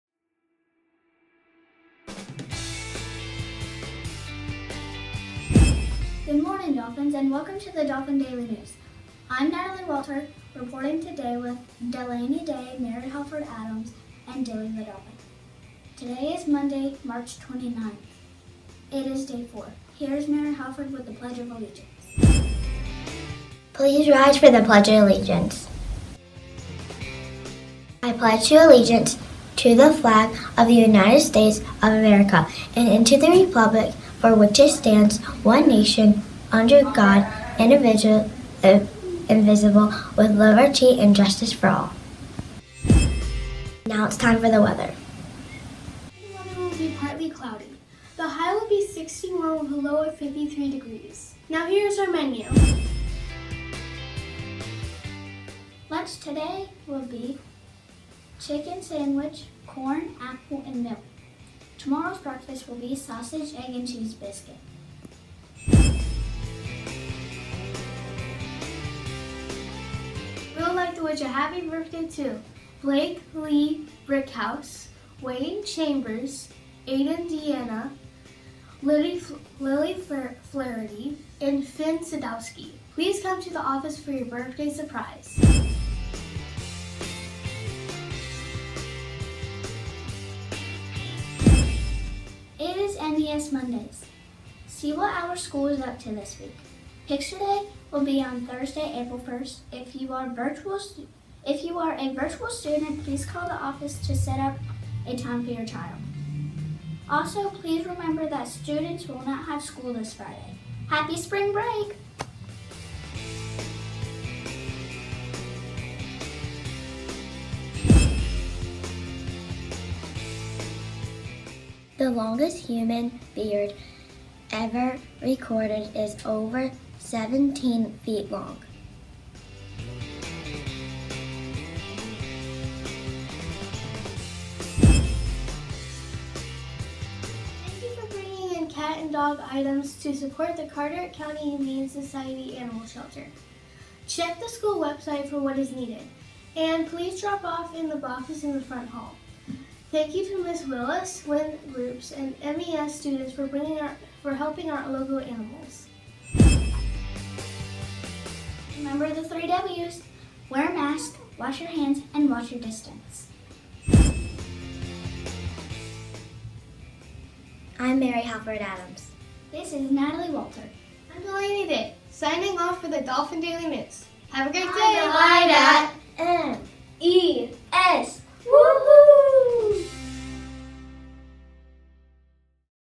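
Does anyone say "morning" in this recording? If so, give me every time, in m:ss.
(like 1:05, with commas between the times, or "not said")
0:06.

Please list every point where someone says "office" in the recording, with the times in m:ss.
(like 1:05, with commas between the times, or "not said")
1:23, 1:43.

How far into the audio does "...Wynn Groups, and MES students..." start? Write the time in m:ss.
2:31.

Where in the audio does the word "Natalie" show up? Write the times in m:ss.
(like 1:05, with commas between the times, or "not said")
0:09, 2:49.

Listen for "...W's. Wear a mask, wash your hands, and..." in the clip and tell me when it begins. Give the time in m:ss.
2:39.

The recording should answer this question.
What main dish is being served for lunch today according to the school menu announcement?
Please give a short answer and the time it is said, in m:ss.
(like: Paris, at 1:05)
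Chicken sandwich, at 0:58.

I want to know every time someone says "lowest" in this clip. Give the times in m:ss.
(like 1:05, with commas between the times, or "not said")
not said.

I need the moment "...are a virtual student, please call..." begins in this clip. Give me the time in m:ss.
1:41.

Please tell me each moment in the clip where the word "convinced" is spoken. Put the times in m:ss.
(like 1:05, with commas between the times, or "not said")
not said.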